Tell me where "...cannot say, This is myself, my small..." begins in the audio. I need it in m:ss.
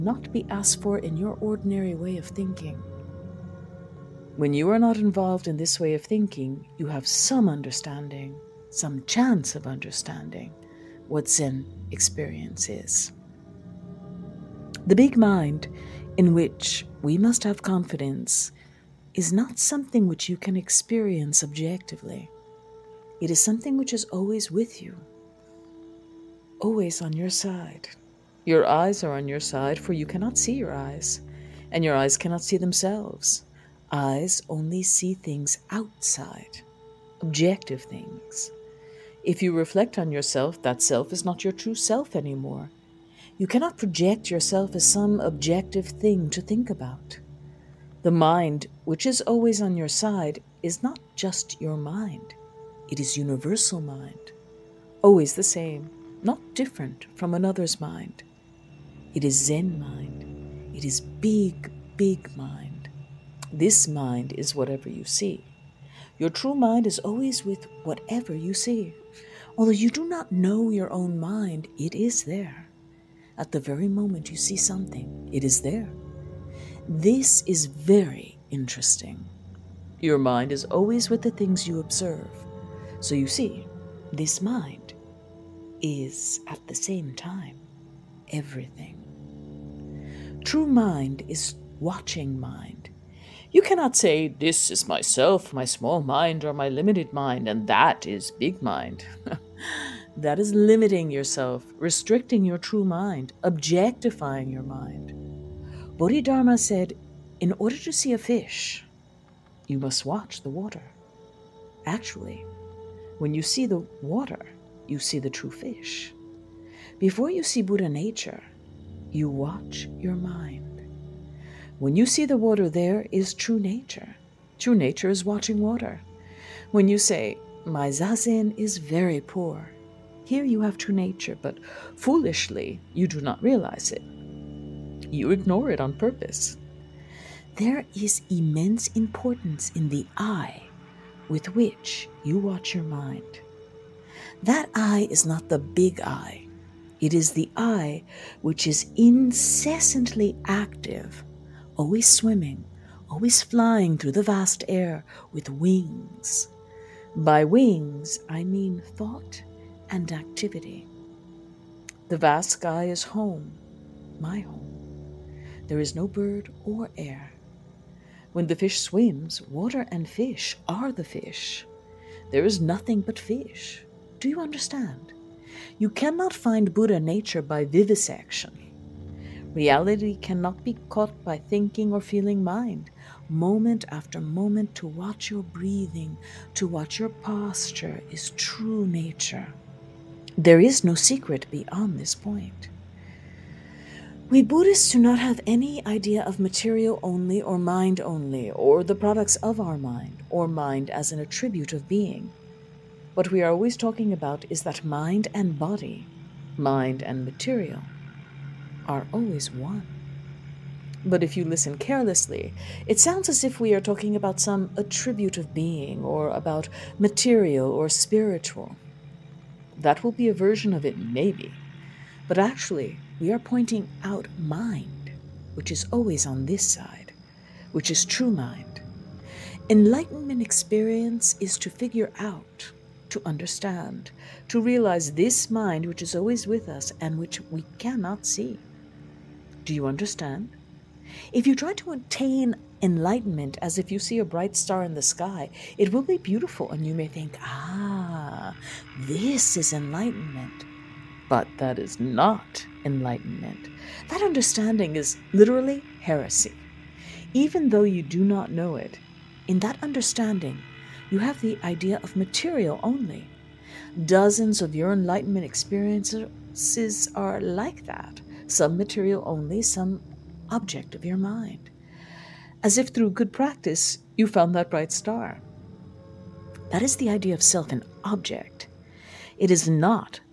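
1:33.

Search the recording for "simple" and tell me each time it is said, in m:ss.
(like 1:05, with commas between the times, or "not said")
not said.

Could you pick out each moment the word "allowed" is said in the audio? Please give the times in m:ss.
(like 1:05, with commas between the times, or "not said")
not said.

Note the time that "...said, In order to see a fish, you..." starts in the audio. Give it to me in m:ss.
1:46.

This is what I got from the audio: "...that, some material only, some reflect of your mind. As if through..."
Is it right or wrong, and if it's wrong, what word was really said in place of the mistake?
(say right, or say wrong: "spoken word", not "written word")
wrong: "object", not "reflect".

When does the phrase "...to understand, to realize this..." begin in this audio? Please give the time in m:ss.
3:53.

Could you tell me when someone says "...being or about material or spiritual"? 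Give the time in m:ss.
3:35.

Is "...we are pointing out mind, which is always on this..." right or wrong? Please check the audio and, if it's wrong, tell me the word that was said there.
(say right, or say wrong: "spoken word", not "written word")
right.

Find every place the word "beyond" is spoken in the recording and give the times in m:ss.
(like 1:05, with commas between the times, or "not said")
3:11.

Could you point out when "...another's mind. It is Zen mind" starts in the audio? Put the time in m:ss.
0:57.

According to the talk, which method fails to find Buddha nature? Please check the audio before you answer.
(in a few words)
vivisection.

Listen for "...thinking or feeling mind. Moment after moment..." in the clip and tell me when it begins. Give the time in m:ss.
3:01.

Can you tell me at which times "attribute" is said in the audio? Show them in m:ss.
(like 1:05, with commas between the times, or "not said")
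3:21, 3:34.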